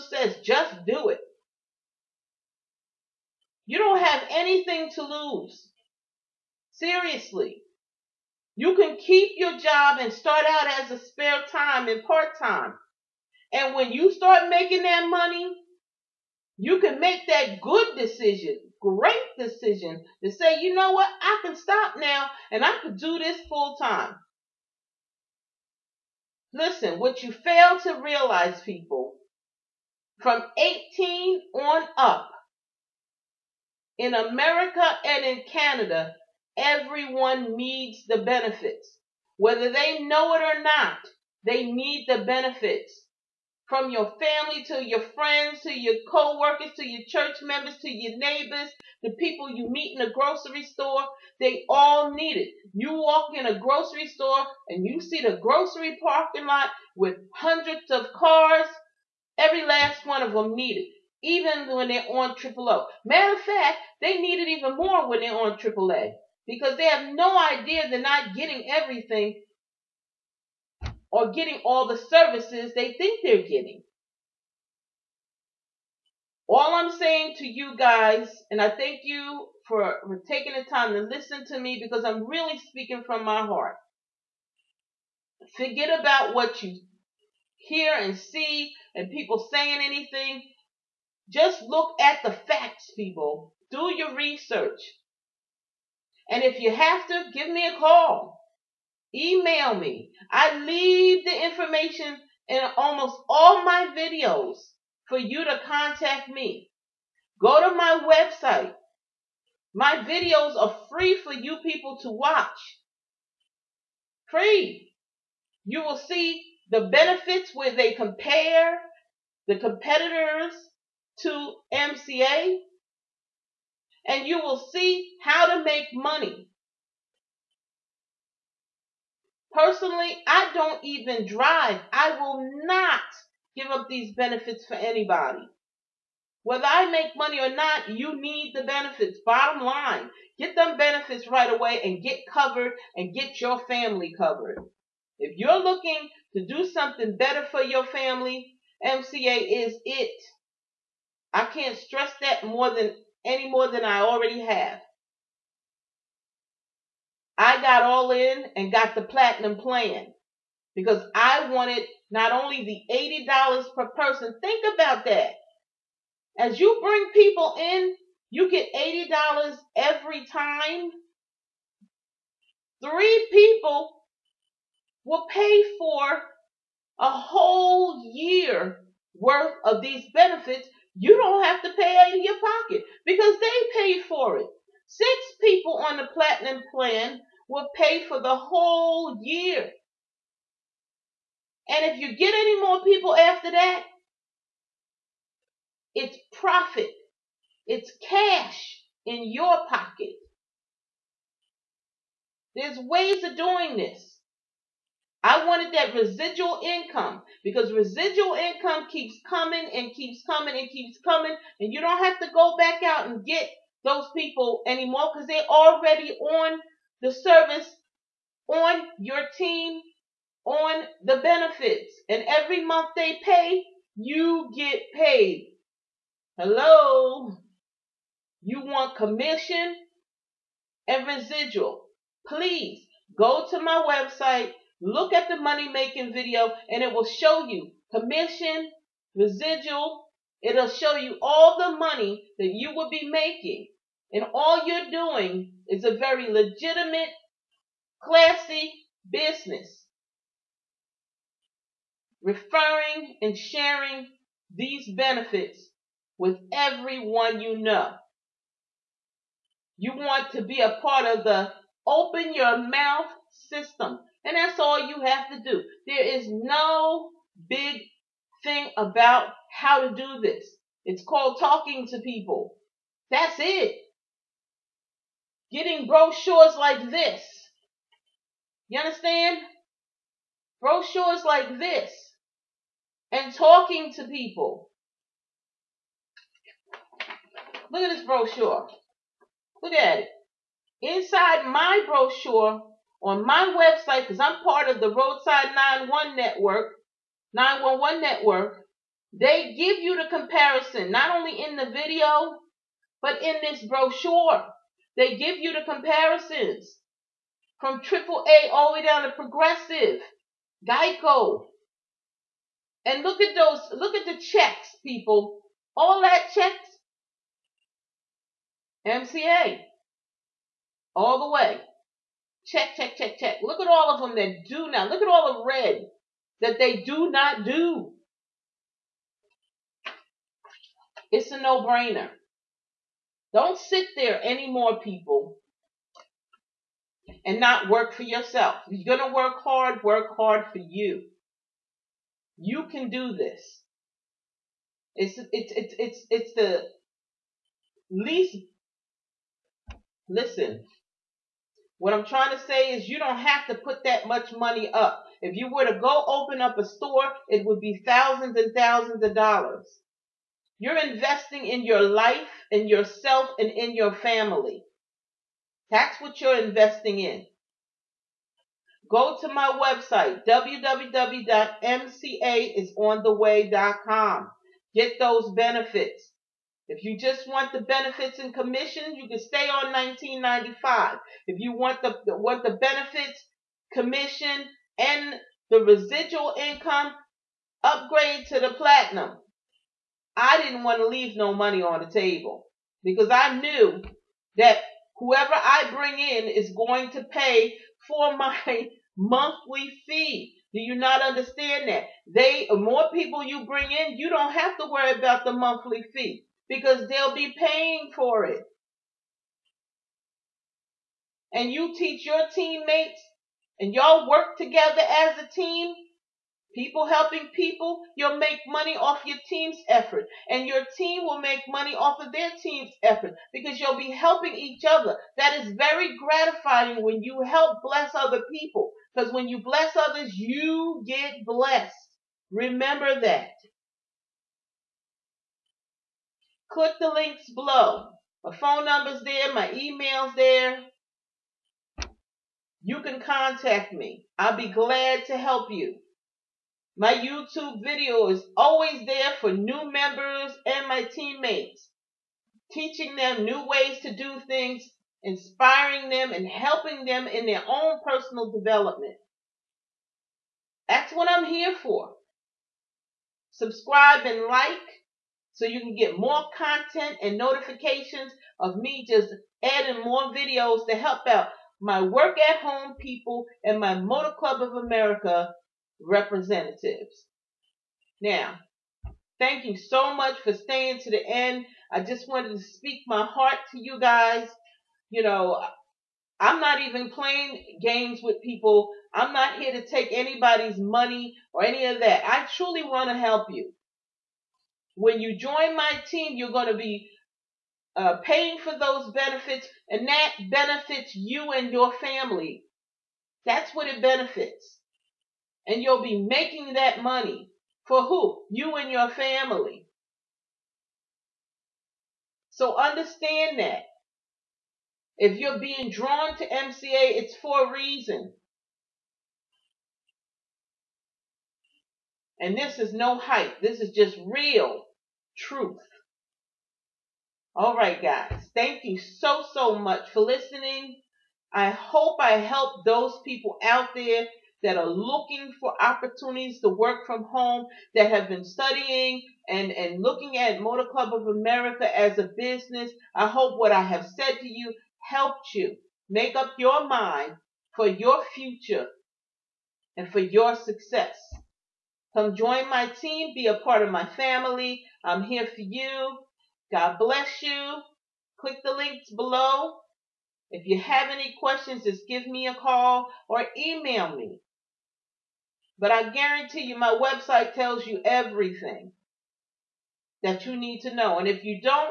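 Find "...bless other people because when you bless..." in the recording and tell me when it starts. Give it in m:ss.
7:07.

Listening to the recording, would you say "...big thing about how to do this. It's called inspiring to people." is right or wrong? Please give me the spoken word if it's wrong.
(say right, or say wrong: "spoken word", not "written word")
wrong: "talking", not "inspiring".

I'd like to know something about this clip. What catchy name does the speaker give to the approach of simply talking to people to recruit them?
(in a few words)
open your mouth system.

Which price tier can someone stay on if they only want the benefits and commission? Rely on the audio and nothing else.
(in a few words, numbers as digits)
1995.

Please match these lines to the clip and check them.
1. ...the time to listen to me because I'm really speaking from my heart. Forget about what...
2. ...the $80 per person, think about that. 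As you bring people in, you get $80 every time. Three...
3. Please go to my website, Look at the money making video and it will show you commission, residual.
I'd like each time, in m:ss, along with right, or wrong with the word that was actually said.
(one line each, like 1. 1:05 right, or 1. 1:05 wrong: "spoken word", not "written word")
1. 1:20 right
2. 2:42 right
3. 3:52 right.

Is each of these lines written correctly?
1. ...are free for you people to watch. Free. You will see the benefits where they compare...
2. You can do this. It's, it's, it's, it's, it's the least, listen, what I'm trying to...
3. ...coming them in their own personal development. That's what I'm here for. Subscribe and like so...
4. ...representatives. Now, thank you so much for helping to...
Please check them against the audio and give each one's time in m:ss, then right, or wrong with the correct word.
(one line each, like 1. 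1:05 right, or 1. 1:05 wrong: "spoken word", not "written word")
1. 1:50 right
2. 5:42 right
3. 7:36 wrong: "helping", not "coming"
4. 7:55 wrong: "staying", not "helping".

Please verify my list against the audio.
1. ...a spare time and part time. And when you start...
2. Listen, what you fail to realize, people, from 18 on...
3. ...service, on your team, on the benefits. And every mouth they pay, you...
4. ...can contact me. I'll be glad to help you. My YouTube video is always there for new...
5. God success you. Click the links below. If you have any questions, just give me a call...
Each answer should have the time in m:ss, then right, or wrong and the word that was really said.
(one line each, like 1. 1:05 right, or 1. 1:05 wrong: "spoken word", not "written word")
1. 0:10 right
2. 0:26 right
3. 3:37 wrong: "month", not "mouth"
4. 7:22 right
5. 9:16 wrong: "bless", not "success".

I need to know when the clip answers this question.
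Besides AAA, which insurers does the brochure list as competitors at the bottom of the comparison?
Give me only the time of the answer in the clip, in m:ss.
5:09.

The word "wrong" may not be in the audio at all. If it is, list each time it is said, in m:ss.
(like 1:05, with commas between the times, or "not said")
not said.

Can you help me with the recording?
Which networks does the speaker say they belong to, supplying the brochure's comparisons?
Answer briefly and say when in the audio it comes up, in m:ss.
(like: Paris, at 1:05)
Roadside one network, 911 network, at 4:54.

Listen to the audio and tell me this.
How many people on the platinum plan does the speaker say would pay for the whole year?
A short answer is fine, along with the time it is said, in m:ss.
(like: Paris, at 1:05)
Six, at 3:04.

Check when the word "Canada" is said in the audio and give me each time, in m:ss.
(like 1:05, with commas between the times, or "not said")
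0:35.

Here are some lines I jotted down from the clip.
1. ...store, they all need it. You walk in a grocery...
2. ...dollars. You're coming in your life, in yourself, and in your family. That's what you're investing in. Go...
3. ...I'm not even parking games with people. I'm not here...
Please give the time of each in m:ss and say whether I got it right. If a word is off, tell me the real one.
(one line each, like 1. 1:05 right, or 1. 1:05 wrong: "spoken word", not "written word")
1. 0:50 right
2. 5:59 wrong: "investing", not "coming"
3. 8:06 wrong: "playing", not "parking".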